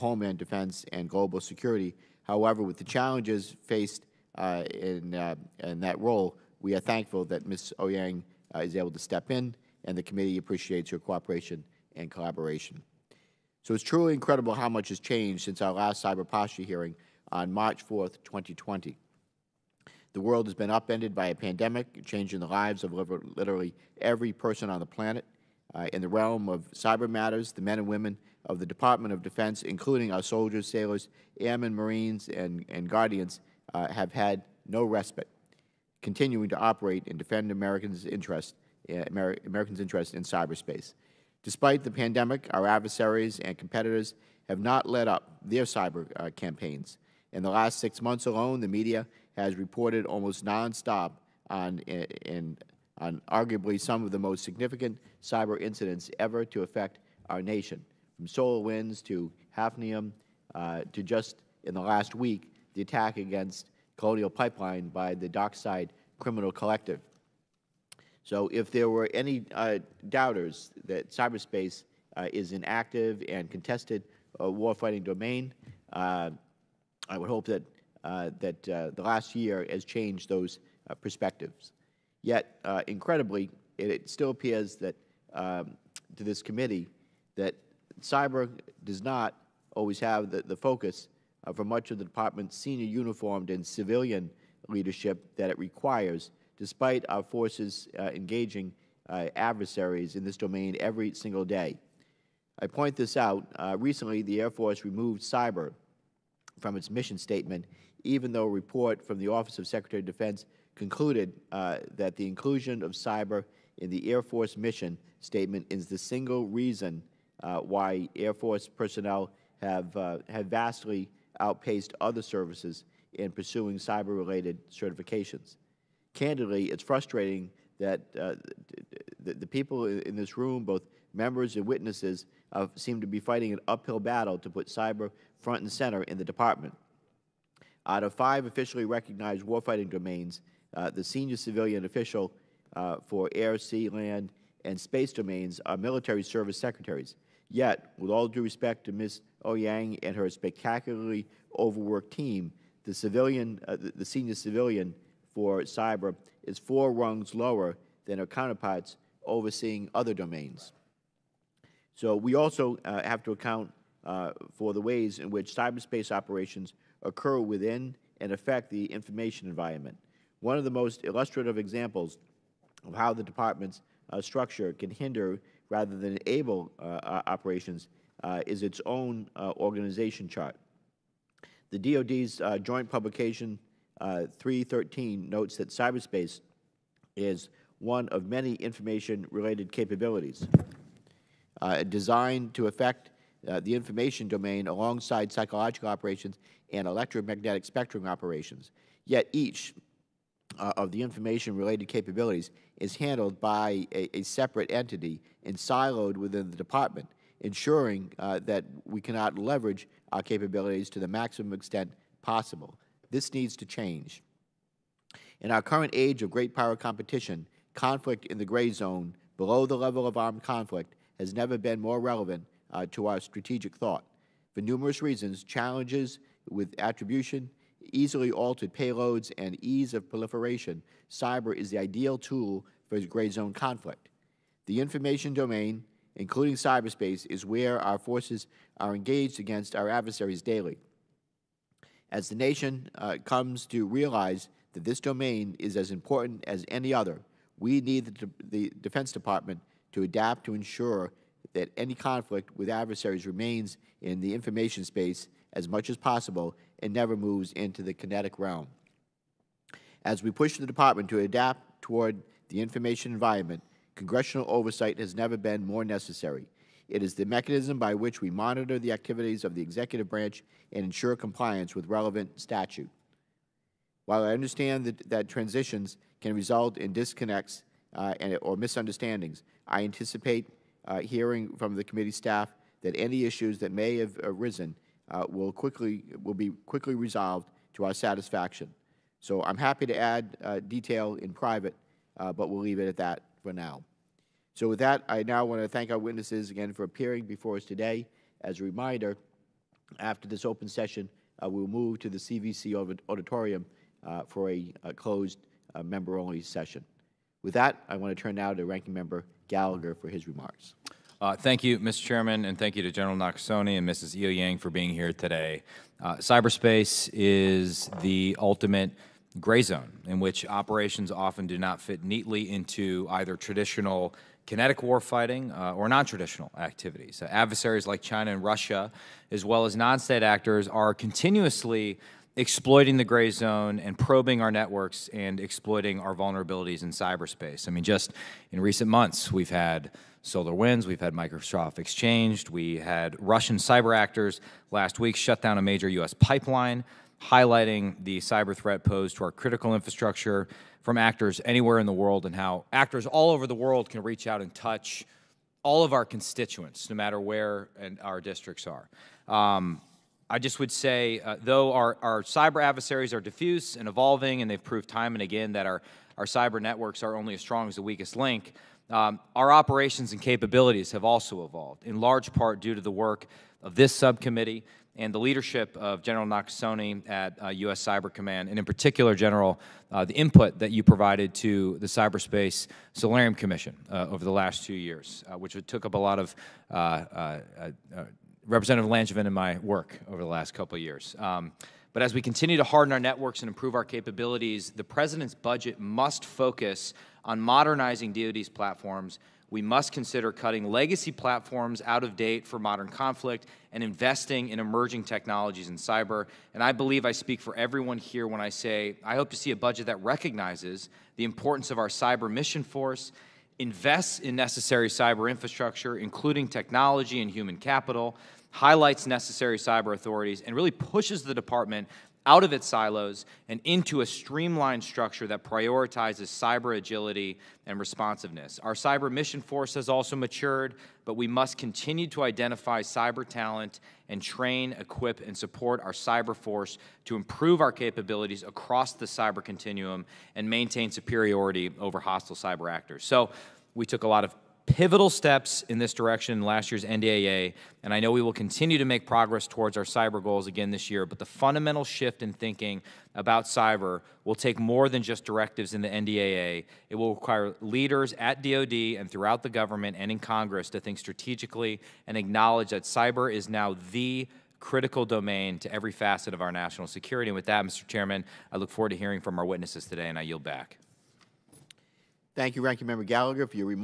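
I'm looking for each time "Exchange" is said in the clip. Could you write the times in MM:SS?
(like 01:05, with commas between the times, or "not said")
05:41.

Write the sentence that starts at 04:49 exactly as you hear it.
So I'm happy to add uh, detail in private, uh, but we'll leave it at that for now.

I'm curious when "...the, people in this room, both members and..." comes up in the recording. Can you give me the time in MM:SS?
02:09.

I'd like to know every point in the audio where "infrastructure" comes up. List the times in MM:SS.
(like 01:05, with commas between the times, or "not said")
05:49, 06:55.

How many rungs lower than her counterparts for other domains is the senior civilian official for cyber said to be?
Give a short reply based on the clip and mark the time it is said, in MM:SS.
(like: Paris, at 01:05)
four, at 02:36.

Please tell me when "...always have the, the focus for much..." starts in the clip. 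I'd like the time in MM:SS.
01:29.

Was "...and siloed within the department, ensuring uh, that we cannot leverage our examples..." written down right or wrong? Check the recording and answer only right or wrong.
wrong.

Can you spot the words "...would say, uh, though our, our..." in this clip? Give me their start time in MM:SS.
06:00.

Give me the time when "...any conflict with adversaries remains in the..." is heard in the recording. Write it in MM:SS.
04:11.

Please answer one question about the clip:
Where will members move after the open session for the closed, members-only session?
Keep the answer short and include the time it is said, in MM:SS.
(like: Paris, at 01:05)
CVC auditorium, at 05:02.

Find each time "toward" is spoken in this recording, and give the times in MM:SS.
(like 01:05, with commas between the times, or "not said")
04:21, 07:29.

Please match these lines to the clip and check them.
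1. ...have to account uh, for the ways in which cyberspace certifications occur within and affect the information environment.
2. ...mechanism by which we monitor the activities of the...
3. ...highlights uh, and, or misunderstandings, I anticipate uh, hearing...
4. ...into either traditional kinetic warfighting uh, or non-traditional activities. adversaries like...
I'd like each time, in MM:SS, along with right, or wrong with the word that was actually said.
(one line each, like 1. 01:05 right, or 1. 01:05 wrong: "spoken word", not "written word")
1. 02:43 wrong: "operations", not "certifications"
2. 04:27 right
3. 04:36 wrong: "disconnects", not "highlights"
4. 05:22 right.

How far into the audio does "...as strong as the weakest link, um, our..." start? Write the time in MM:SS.
06:07.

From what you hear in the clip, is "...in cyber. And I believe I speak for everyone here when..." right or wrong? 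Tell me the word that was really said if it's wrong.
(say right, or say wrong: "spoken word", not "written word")
right.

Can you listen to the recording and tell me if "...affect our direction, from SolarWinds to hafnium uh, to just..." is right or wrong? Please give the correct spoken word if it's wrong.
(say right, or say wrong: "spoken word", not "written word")
wrong: "nation", not "direction".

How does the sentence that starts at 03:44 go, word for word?
For numerous reasons, challenges with attribution, easily altered payloads, and ease of proliferation, cyber is the ideal tool for gray zone conflict.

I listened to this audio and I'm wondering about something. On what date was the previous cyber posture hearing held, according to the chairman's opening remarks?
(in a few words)
March 4th, 2020.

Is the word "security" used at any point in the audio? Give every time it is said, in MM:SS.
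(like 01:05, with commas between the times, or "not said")
00:01, 07:46.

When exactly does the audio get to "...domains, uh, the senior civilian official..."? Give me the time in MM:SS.
02:19.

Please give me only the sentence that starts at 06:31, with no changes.
Um, but as we continue to harden our networks and improve our capabilities, the president's budget must focus on modernizing DoD's platforms.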